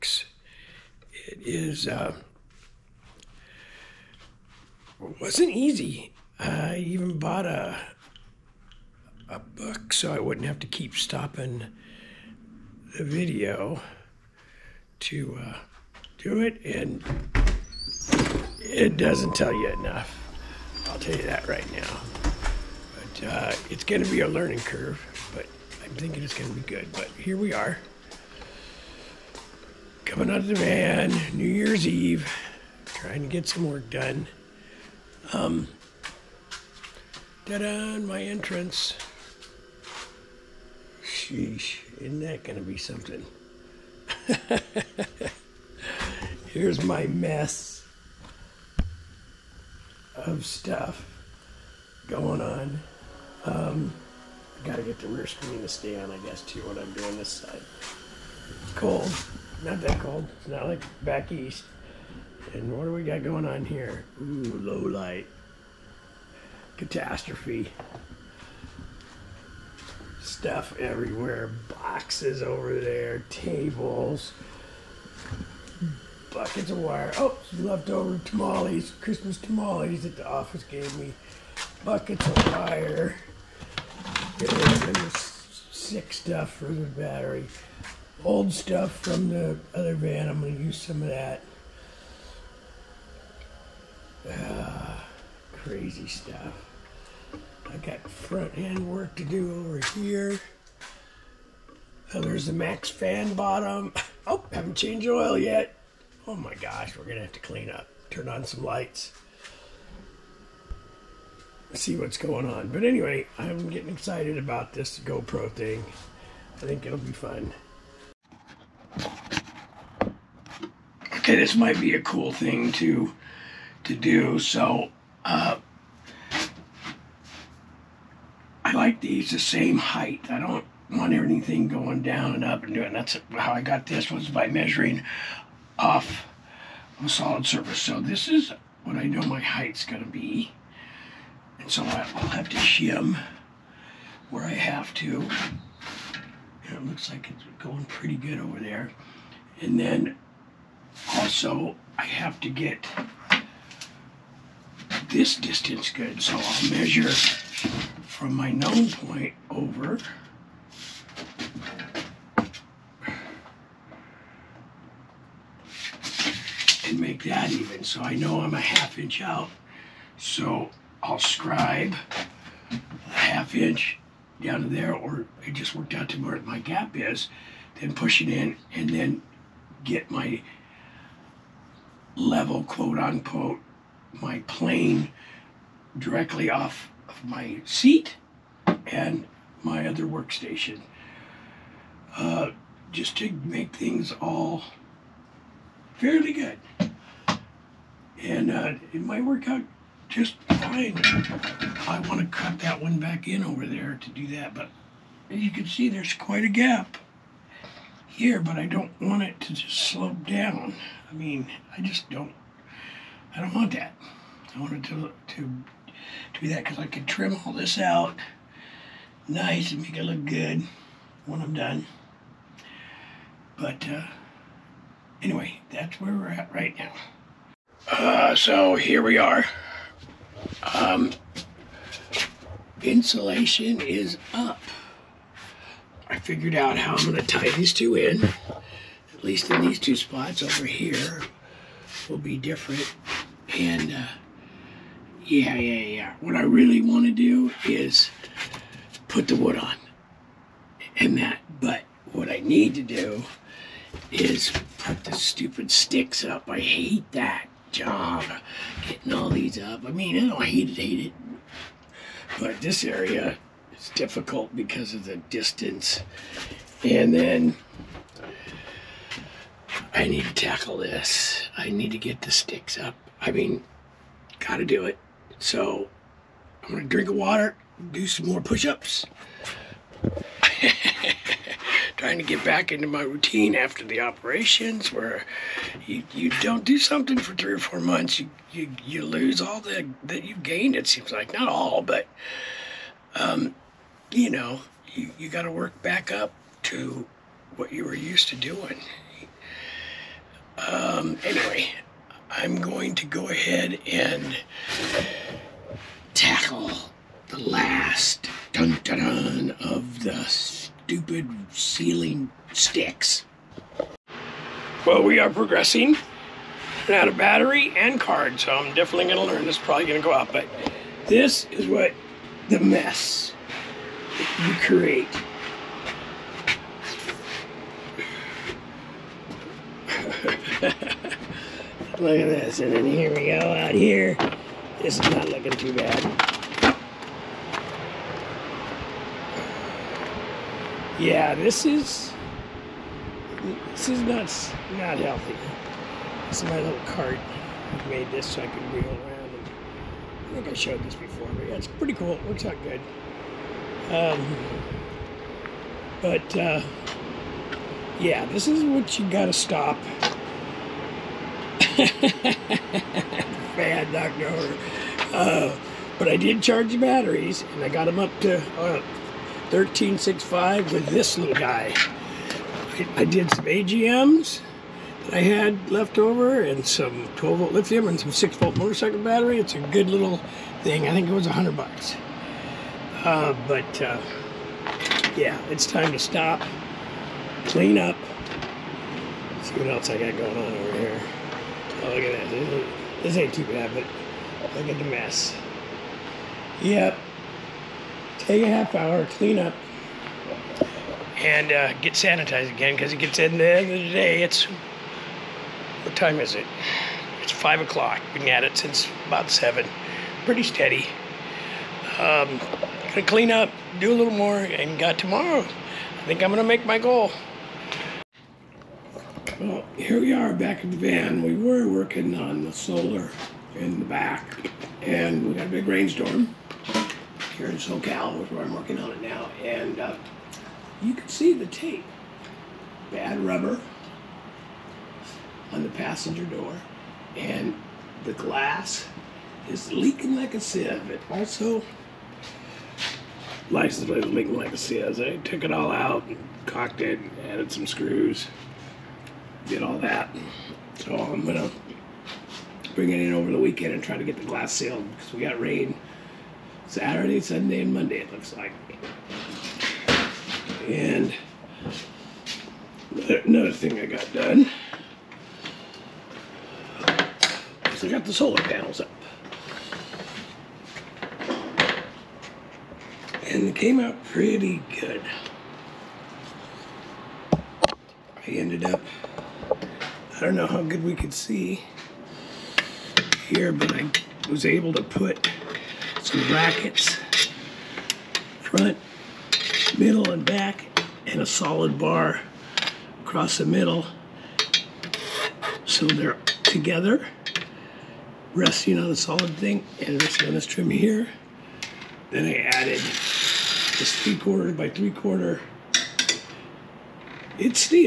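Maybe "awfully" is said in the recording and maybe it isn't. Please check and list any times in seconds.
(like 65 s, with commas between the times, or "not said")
not said.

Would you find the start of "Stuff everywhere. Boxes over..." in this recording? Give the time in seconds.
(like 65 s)
70 s.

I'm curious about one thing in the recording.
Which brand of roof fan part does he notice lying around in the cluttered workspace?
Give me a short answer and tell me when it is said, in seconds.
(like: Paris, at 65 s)
MaxxFan, at 102 s.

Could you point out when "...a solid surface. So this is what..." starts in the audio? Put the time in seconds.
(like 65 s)
137 s.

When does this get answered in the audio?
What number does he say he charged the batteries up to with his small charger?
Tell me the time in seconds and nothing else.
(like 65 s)
369 s.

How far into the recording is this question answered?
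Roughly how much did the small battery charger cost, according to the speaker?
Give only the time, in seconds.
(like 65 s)
381 s.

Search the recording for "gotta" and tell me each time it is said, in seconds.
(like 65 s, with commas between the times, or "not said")
54 s, 274 s, 359 s.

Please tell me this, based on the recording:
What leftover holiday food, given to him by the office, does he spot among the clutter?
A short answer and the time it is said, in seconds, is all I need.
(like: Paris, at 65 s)
Christmas tamales, at 78 s.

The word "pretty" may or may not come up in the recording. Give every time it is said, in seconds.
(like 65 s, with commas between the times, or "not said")
147 s, 351 s, 410 s, 474 s.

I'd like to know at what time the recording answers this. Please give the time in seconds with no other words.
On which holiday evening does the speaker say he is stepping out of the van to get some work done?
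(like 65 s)
31 s.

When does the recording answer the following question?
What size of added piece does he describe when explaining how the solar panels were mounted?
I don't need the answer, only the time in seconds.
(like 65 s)
504 s.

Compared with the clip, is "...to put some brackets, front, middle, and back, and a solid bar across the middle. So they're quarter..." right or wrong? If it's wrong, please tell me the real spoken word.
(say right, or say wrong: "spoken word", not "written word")
wrong: "together", not "quarter".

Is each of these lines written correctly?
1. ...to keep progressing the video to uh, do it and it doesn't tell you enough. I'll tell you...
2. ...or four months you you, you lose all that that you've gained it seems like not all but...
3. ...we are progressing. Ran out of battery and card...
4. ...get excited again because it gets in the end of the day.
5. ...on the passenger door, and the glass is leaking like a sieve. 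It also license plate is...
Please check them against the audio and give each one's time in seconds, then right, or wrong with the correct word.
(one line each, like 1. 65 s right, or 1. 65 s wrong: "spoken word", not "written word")
1. 10 s wrong: "stopping", not "progressing"
2. 287 s right
3. 315 s right
4. 401 s wrong: "sanitized", not "excited"
5. 435 s right.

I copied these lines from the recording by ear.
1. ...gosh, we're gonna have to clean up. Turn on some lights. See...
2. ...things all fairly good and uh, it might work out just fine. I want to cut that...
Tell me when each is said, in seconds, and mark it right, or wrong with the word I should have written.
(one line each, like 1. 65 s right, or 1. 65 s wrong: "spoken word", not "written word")
1. 106 s right
2. 193 s right.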